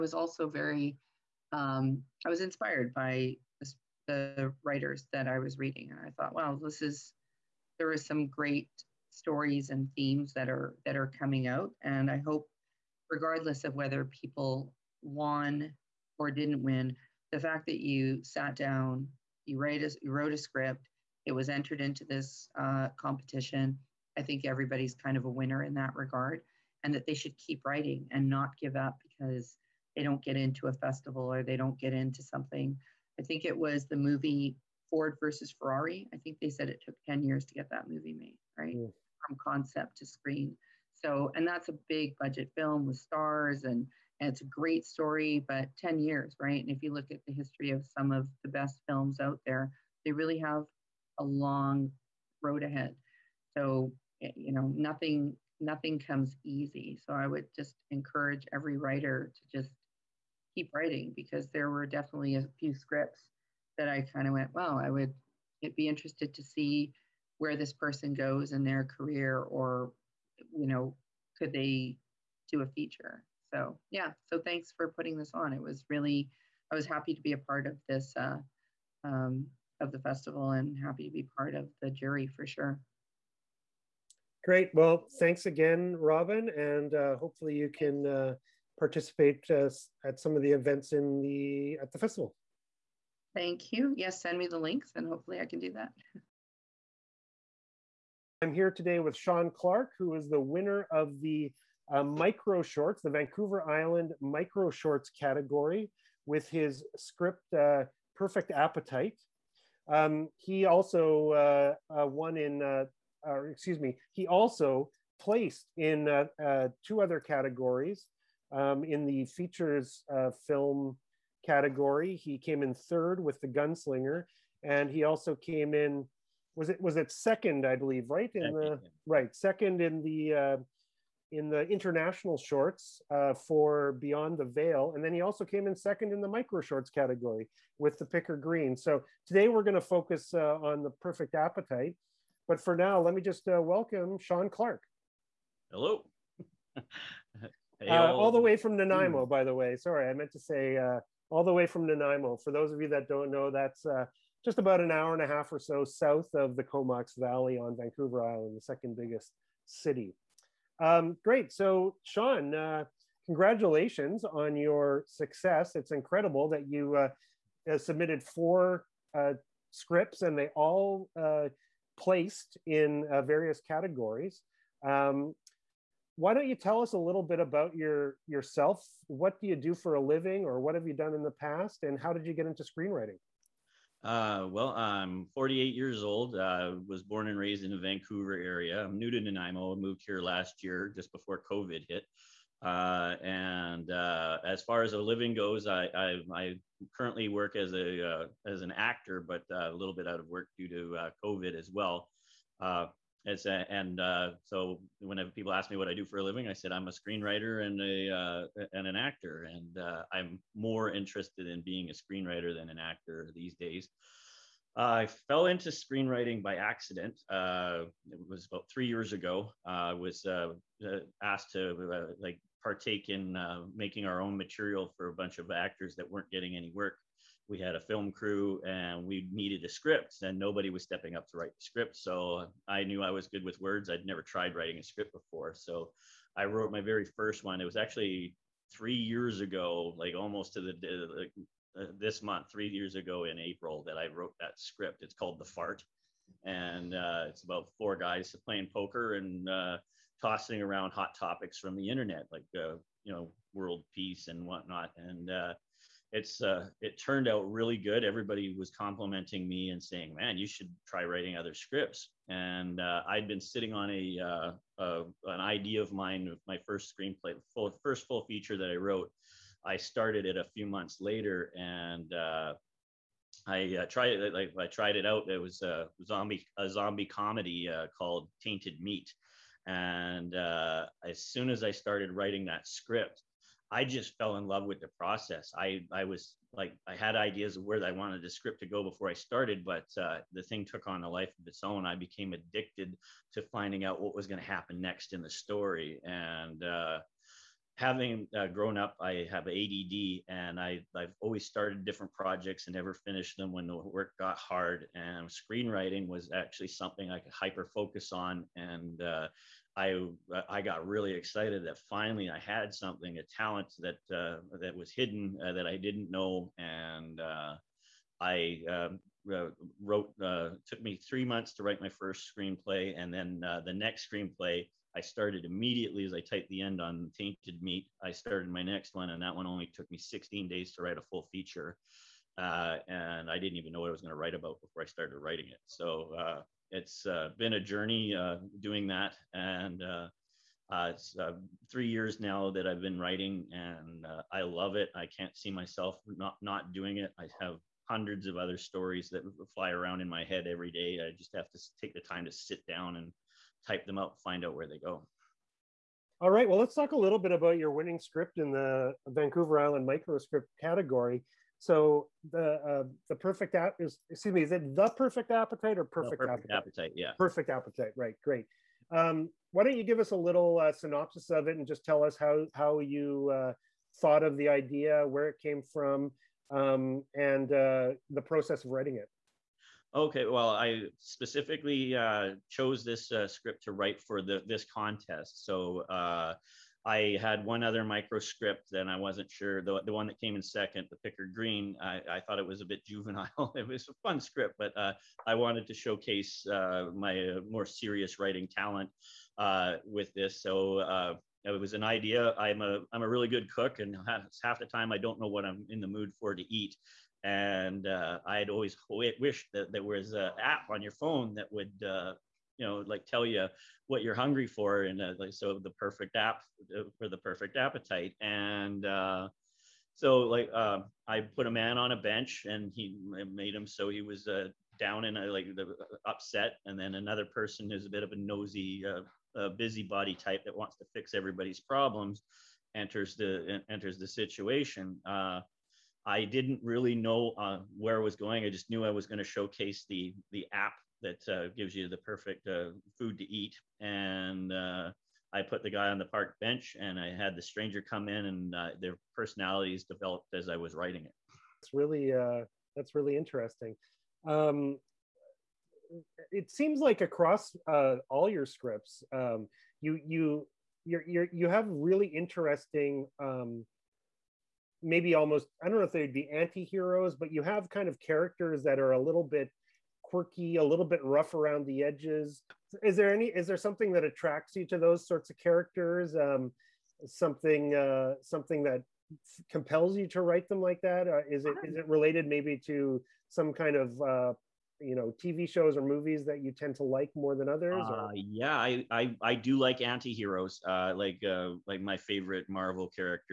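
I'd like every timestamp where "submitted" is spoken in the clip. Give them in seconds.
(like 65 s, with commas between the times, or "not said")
167 s.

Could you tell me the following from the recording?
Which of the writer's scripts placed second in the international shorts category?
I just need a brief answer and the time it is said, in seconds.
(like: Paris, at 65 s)
Beyond the Veil, at 133 s.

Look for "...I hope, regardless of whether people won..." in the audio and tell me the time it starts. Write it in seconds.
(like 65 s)
12 s.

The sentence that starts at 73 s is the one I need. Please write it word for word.
So, yeah, so thanks for putting this on.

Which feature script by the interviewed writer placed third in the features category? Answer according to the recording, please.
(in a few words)
The Gunslinger.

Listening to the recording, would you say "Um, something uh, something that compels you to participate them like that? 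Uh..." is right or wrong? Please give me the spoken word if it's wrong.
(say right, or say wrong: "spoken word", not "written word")
wrong: "write", not "participate".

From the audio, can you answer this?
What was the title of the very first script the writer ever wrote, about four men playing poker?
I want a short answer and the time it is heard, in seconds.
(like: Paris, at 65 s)
The Fart, at 245 s.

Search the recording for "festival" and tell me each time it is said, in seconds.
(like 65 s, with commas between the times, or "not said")
30 s, 79 s, 91 s.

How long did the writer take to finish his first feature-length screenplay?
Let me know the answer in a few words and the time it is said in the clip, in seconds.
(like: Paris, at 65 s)
3 months, at 320 s.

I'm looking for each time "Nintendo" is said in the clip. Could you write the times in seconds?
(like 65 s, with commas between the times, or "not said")
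not said.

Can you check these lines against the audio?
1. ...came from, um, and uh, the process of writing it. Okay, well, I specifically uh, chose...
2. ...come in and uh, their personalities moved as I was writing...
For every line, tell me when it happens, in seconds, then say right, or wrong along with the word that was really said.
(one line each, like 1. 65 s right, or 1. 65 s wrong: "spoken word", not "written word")
1. 375 s right
2. 447 s wrong: "developed", not "moved".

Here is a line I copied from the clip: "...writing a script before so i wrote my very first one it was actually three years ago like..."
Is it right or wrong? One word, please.
right.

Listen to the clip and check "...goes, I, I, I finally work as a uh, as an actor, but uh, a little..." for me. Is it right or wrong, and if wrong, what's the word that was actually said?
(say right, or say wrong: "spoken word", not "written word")
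wrong: "currently", not "finally".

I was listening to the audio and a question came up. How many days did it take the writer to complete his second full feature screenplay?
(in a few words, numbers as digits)
16.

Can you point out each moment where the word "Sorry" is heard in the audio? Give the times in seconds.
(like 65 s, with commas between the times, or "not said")
149 s.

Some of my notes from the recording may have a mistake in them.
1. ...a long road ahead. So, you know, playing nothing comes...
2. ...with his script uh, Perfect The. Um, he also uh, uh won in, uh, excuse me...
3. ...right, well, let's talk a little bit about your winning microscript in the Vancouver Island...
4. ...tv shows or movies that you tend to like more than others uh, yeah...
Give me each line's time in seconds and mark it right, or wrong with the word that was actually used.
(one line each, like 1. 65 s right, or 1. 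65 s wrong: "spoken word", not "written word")
1. 51 s wrong: "nothing", not "playing"
2. 106 s wrong: "Appetite", not "The"
3. 356 s wrong: "script", not "microscript"
4. 485 s right.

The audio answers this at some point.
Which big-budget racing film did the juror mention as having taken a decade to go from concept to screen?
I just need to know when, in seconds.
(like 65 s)
34 s.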